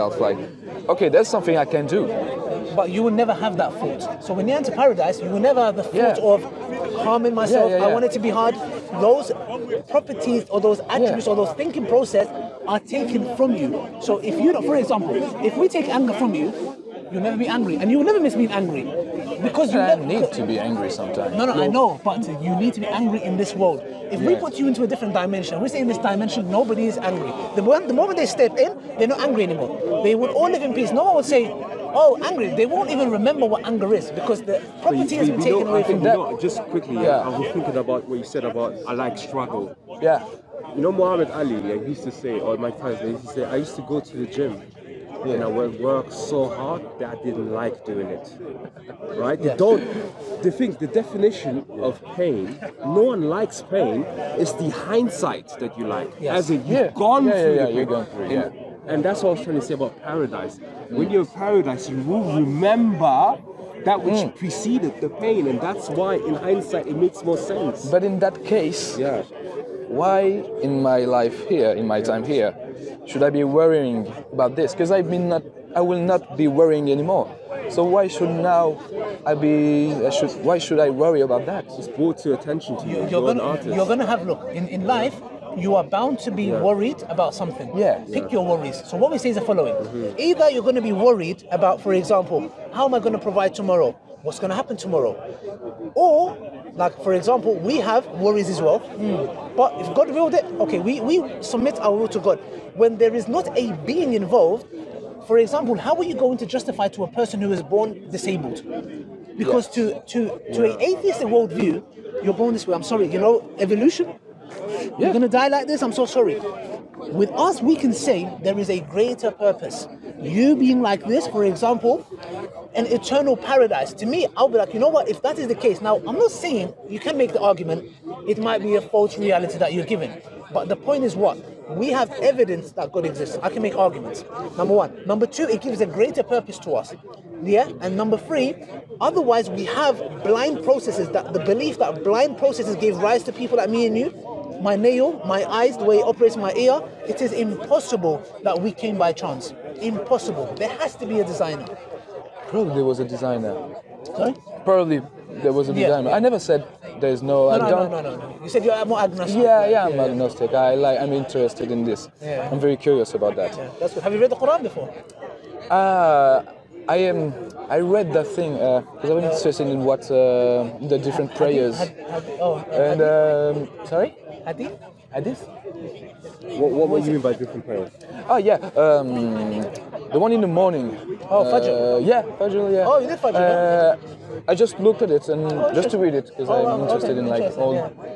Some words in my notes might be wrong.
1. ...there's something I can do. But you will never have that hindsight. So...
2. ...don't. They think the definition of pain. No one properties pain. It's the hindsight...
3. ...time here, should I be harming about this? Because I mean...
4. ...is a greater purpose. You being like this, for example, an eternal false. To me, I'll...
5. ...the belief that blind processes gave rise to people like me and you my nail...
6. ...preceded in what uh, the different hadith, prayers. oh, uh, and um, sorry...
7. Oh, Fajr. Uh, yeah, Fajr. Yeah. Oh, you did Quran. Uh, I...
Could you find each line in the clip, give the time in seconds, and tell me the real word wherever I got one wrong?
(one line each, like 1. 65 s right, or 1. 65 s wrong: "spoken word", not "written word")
1. 1 s wrong: "thought", not "hindsight"
2. 49 s wrong: "likes", not "properties"
3. 72 s wrong: "worrying", not "harming"
4. 118 s wrong: "paradise", not "false"
5. 141 s right
6. 169 s wrong: "interested", not "preceded"
7. 181 s wrong: "Fajr", not "Quran".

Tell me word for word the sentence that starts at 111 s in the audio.
an worldview, you're born this way.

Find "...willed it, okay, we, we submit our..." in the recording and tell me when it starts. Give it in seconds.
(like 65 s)
100 s.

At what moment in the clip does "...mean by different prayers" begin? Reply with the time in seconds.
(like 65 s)
177 s.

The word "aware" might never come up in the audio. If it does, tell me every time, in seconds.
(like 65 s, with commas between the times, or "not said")
not said.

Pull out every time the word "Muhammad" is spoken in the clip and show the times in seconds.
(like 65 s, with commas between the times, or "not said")
40 s.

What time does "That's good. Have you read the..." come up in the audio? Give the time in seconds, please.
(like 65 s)
163 s.